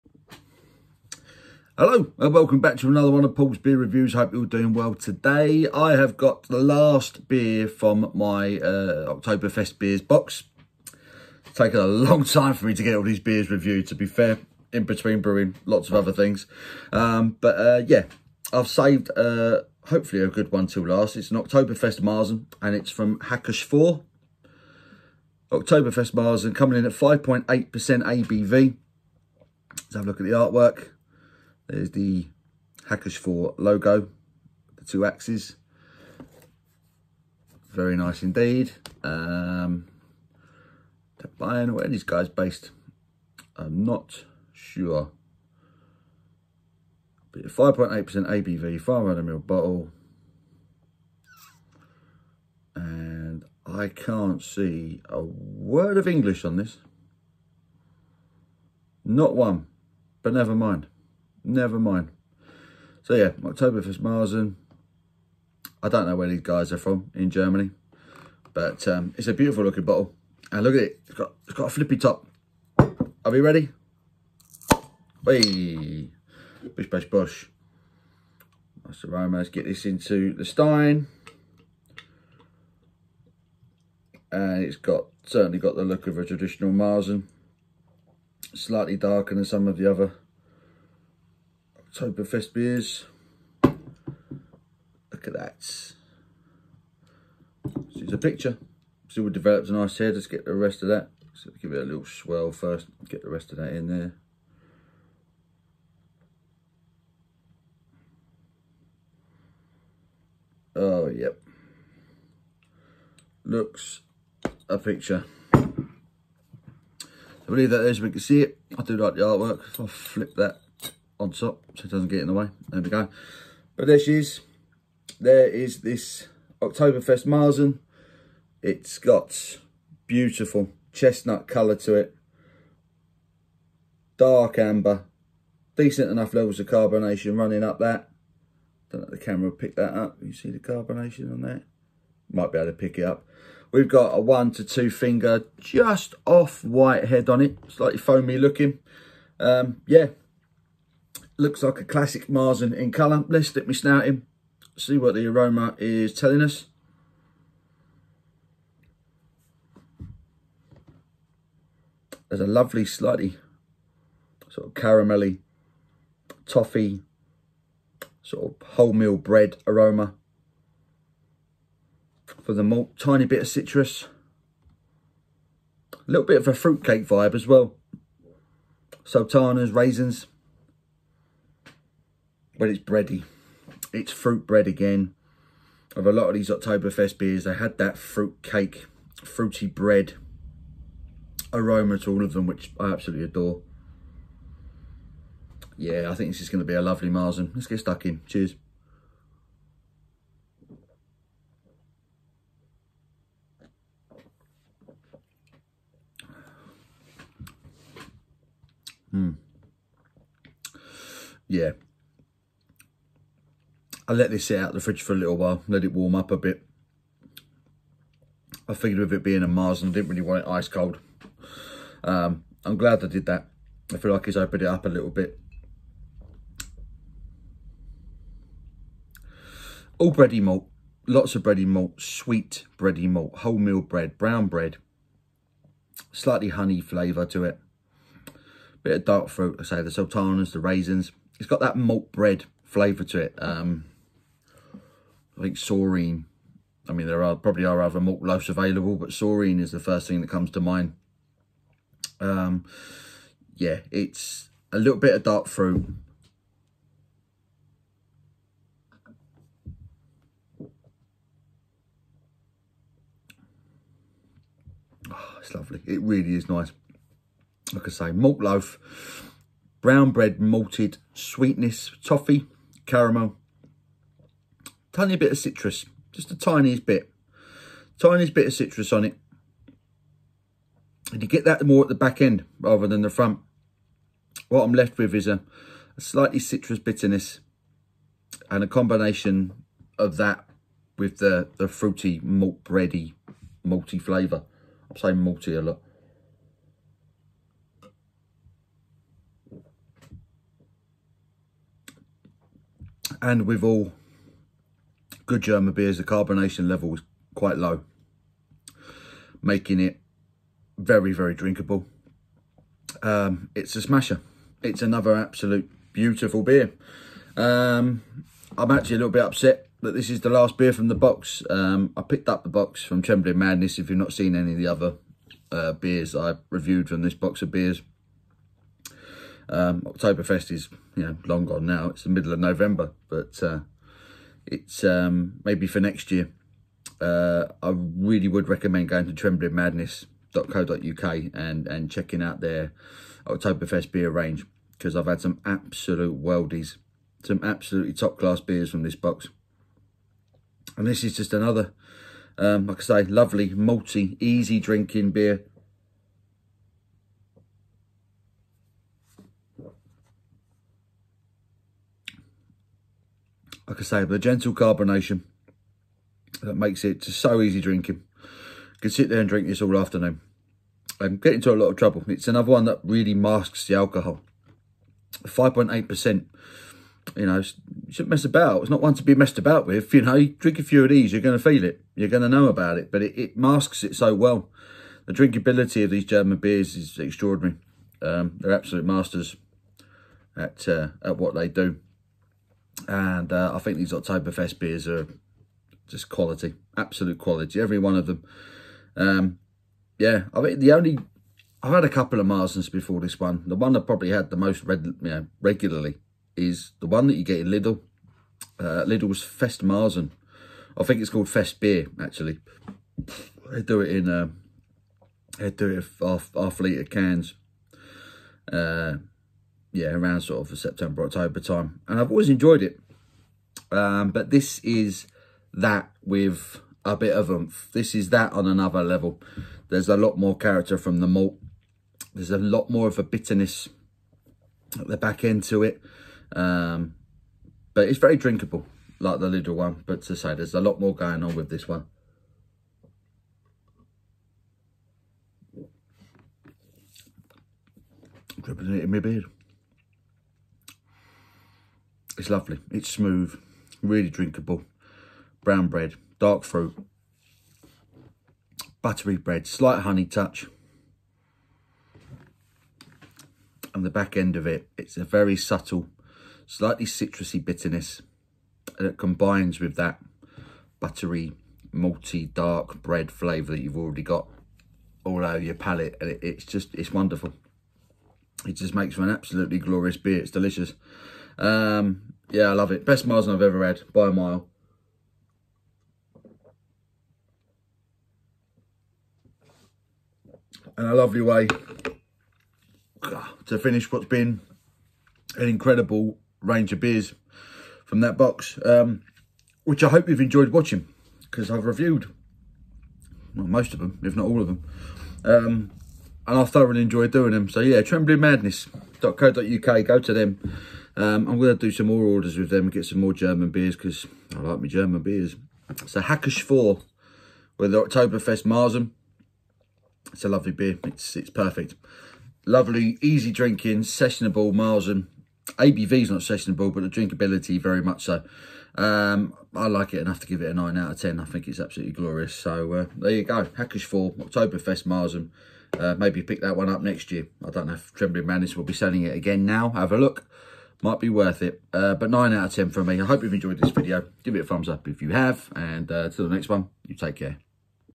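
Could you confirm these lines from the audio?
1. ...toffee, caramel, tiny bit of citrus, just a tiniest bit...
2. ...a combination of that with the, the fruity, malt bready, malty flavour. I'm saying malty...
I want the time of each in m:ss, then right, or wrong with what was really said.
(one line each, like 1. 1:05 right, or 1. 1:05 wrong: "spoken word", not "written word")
1. 4:32 right
2. 4:48 right.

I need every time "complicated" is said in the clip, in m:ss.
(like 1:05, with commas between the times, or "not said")
not said.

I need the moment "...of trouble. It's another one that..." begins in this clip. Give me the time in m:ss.
6:11.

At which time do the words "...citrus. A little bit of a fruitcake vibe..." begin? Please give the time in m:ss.
2:53.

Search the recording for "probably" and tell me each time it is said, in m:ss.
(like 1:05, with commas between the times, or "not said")
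4:07, 6:43.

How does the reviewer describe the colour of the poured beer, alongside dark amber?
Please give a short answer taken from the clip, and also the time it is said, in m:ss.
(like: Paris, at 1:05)
chestnut, at 2:10.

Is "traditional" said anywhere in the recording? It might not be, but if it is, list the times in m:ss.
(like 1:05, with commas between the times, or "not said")
1:26.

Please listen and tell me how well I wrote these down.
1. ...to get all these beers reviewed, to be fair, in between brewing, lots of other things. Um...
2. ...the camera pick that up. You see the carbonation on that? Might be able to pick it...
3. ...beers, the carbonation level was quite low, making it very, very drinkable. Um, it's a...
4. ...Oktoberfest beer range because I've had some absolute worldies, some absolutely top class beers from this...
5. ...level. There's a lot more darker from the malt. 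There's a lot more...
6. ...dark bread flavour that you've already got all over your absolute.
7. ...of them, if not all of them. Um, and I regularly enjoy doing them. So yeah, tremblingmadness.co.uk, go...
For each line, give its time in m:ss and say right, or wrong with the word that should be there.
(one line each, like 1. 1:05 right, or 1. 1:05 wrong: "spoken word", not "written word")
1. 0:12 right
2. 2:19 right
3. 5:05 right
4. 5:43 right
5. 7:08 wrong: "character", not "darker"
6. 7:52 wrong: "palate", not "absolute"
7. 8:23 wrong: "thoroughly", not "regularly".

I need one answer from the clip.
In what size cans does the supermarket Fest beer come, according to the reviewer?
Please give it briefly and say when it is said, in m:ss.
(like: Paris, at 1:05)
half litre, at 6:56.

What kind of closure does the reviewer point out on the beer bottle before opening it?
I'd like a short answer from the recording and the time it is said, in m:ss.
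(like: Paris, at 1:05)
flippy top, at 1:11.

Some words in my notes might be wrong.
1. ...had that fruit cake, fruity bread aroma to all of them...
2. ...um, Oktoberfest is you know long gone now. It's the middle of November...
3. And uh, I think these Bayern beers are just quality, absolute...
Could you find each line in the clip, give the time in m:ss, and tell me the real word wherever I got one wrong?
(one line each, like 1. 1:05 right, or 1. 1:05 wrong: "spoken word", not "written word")
1. 3:07 right
2. 5:29 right
3. 6:32 wrong: "Oktoberfest", not "Bayern".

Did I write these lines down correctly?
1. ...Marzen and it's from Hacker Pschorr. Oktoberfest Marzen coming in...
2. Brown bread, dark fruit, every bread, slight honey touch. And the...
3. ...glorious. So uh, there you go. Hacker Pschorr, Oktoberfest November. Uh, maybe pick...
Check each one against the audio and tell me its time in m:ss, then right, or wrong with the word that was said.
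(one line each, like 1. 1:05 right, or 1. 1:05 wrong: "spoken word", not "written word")
1. 0:22 right
2. 7:35 wrong: "buttery", not "every"
3. 8:51 wrong: "Marzen", not "November".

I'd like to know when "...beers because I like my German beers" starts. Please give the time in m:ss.
8:33.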